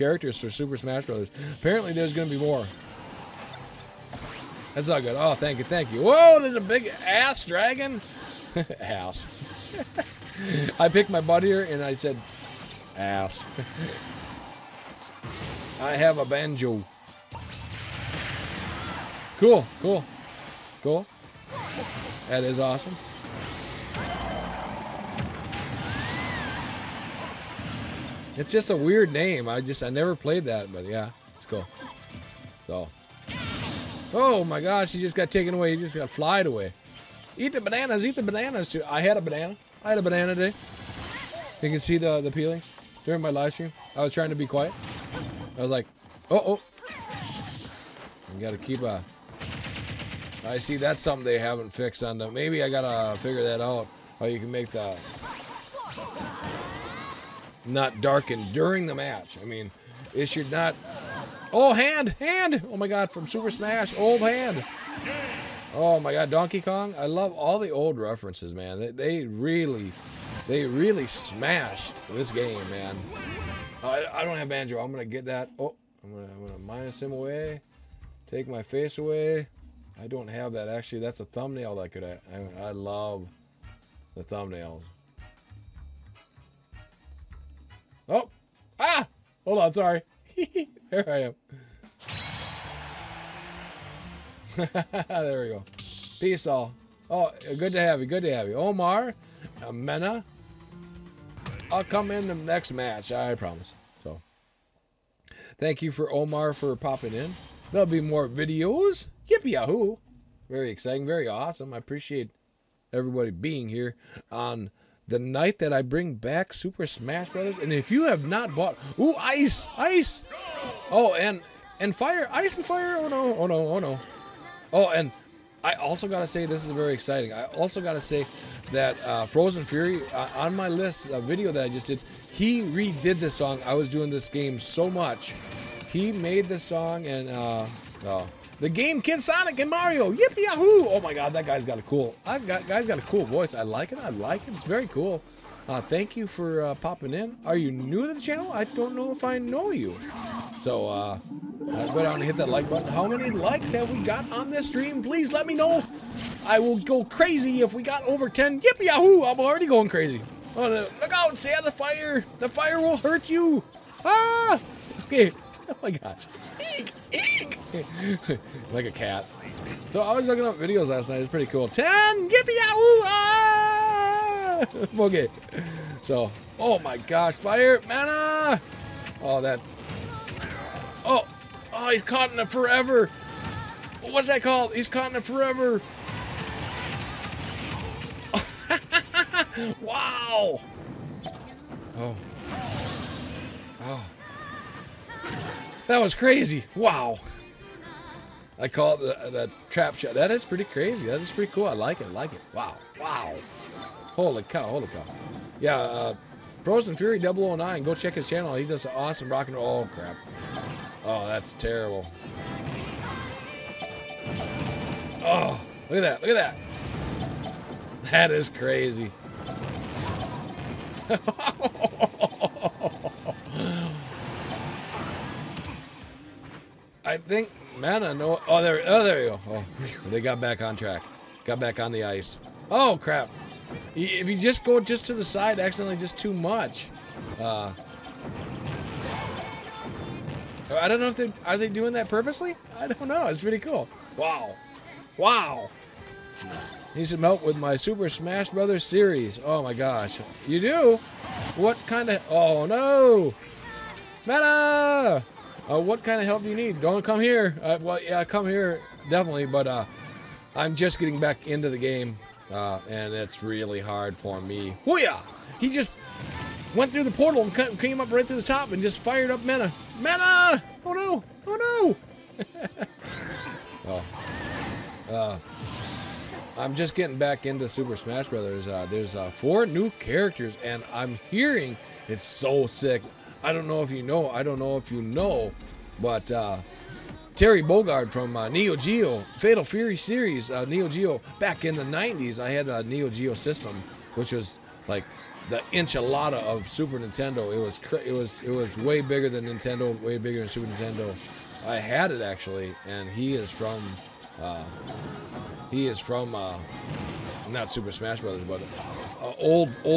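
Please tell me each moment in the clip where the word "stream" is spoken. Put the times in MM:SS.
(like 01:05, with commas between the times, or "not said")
00:43, 02:34.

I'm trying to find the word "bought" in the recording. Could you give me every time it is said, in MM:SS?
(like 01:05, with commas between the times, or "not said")
01:58.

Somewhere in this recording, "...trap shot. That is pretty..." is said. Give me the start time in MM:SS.
03:19.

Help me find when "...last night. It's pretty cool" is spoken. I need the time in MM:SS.
02:50.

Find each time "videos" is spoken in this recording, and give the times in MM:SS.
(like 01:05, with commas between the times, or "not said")
01:48, 02:11, 02:50.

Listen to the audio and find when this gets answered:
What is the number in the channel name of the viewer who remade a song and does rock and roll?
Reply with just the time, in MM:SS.
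03:26.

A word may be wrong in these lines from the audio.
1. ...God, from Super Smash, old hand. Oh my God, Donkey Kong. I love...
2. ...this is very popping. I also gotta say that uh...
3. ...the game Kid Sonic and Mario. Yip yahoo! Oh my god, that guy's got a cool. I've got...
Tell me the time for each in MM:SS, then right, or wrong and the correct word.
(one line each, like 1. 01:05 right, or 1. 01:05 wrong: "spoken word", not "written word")
1. 01:02 right
2. 02:06 wrong: "exciting", not "popping"
3. 02:18 right.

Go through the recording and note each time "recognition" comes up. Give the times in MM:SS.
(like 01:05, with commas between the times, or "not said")
not said.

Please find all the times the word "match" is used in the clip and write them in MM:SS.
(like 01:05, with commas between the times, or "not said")
00:58, 01:42.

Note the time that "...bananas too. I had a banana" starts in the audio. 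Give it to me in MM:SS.
00:38.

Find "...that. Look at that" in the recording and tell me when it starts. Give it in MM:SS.
03:36.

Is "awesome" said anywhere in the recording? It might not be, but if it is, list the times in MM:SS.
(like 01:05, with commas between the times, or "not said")
00:22, 01:51, 03:28.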